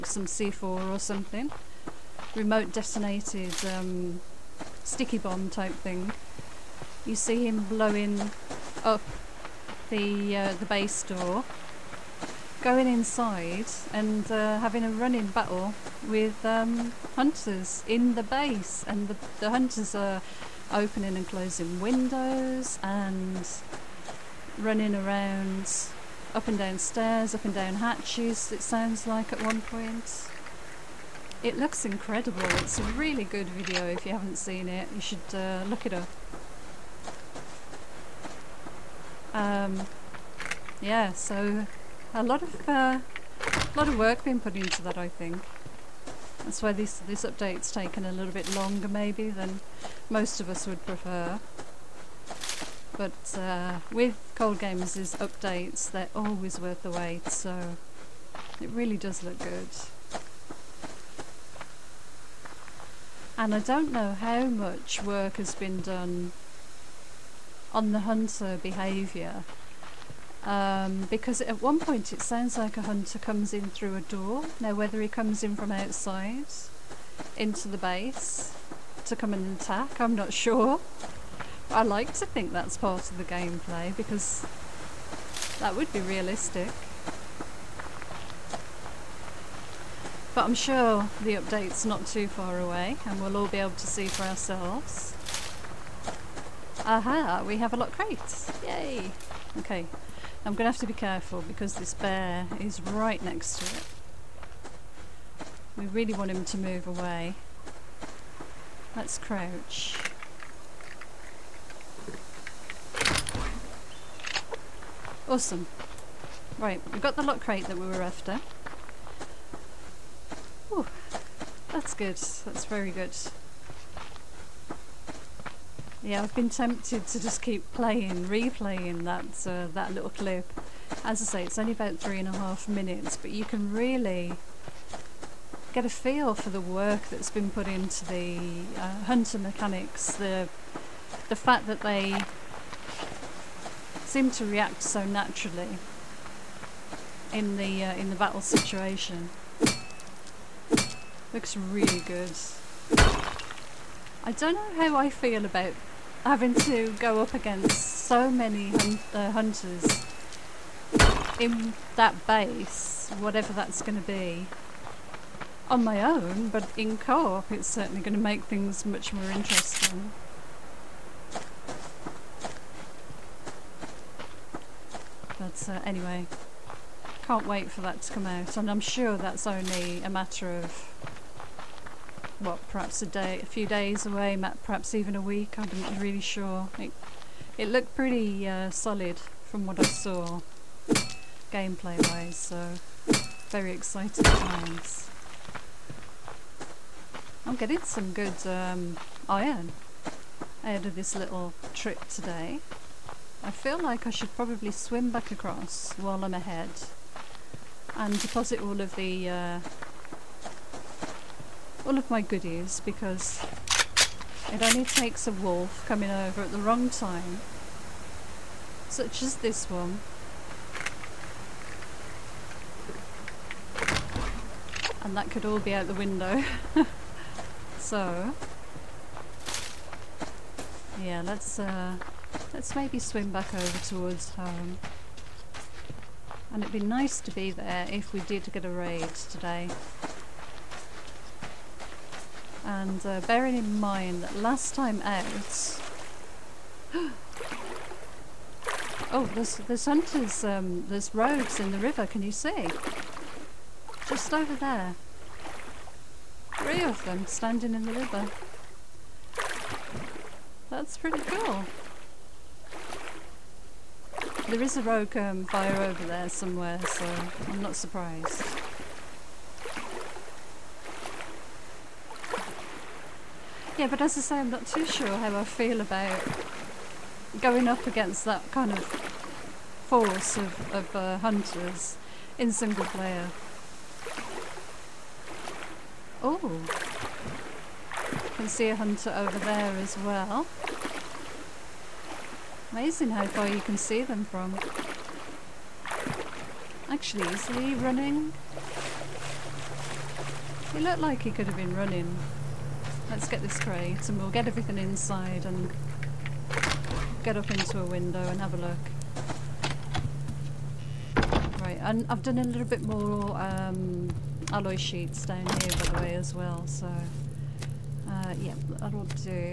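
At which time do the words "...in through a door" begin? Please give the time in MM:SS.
01:13.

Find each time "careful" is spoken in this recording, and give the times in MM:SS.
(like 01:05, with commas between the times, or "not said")
01:40.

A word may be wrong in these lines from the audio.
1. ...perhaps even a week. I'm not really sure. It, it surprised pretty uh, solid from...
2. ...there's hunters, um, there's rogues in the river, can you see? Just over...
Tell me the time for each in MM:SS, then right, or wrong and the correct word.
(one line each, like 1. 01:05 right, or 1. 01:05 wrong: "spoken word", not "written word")
1. 03:04 wrong: "looked", not "surprised"
2. 04:09 right.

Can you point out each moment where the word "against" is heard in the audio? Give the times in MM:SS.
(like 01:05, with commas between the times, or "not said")
02:37, 04:37.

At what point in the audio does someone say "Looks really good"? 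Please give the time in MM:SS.
02:31.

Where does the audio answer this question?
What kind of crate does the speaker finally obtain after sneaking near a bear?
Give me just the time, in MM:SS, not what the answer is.
01:57.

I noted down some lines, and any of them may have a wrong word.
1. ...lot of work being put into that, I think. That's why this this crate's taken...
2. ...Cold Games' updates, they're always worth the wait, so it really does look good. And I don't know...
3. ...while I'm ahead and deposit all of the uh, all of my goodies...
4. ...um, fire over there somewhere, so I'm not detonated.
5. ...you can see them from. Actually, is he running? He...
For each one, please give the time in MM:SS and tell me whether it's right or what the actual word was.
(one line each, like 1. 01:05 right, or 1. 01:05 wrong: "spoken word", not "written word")
1. 00:43 wrong: "update", not "crate"
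2. 00:54 right
3. 03:25 right
4. 04:25 wrong: "surprised", not "detonated"
5. 04:53 right.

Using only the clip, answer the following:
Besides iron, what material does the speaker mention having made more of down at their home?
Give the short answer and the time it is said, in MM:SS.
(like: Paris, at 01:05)
Alloy sheets, at 05:14.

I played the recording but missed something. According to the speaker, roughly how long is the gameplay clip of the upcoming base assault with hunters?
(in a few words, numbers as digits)
3.5 minutes.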